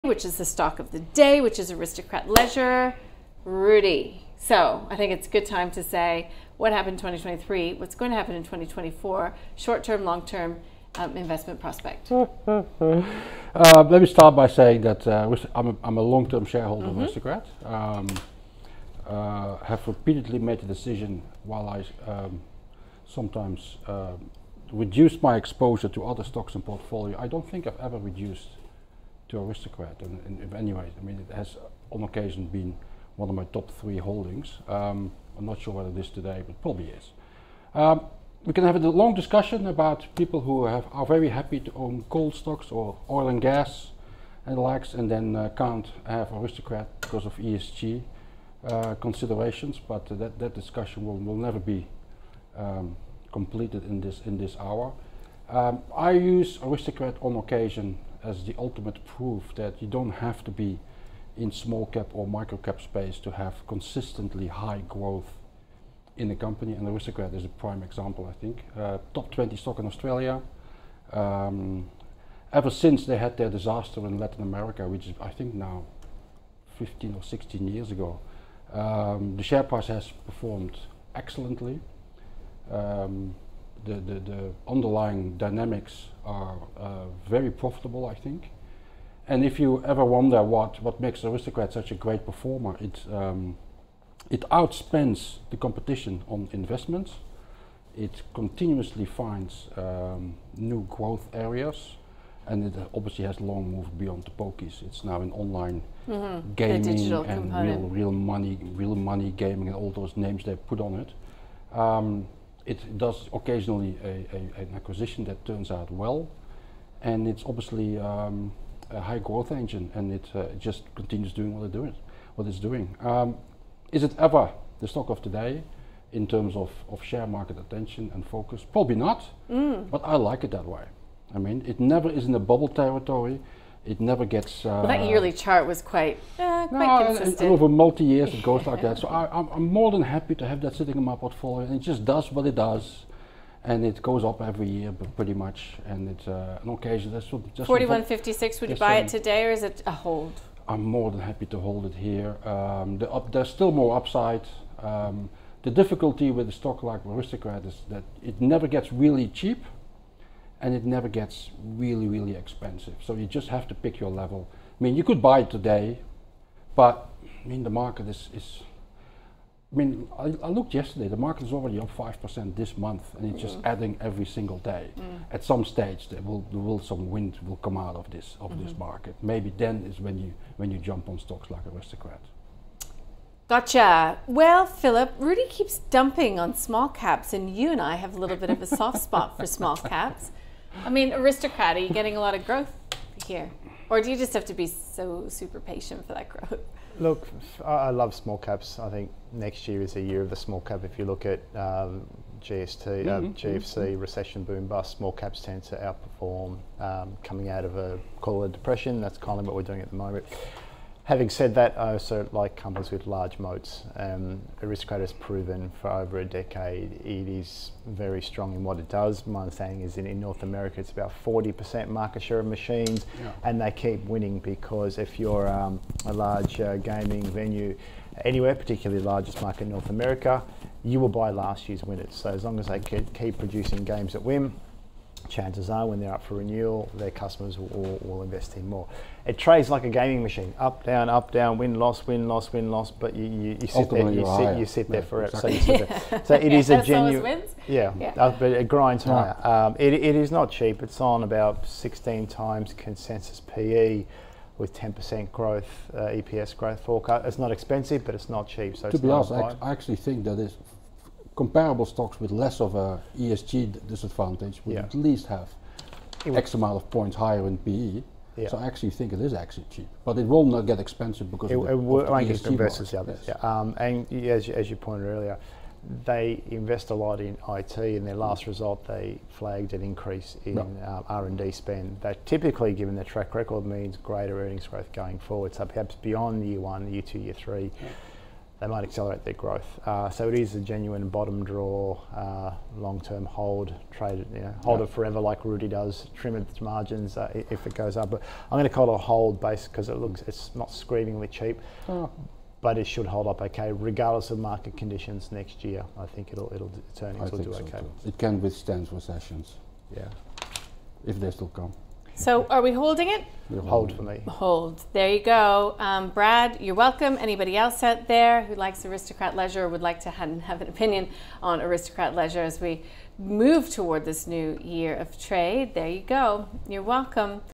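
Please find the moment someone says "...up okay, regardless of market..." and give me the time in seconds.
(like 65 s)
303 s.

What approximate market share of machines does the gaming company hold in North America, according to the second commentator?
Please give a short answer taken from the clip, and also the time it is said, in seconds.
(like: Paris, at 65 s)
40%, at 221 s.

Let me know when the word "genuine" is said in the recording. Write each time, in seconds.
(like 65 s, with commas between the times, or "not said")
246 s, 290 s.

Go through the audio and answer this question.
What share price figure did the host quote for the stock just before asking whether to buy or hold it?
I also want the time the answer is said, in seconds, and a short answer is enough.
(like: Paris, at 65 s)
41.56, at 147 s.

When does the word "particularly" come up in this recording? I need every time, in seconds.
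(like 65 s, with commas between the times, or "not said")
228 s.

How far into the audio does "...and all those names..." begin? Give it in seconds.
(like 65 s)
109 s.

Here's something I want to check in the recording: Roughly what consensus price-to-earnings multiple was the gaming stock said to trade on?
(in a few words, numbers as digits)
16 times.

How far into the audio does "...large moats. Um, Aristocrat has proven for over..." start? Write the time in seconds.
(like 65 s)
213 s.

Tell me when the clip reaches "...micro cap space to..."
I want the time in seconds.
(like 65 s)
62 s.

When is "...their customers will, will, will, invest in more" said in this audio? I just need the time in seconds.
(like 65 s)
236 s.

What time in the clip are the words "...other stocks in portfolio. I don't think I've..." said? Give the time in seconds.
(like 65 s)
26 s.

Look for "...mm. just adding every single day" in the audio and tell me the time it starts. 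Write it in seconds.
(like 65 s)
173 s.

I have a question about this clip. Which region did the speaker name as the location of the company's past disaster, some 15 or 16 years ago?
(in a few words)
Latin America.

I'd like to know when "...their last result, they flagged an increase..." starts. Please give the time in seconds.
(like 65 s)
278 s.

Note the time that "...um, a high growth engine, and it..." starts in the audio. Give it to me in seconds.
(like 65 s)
117 s.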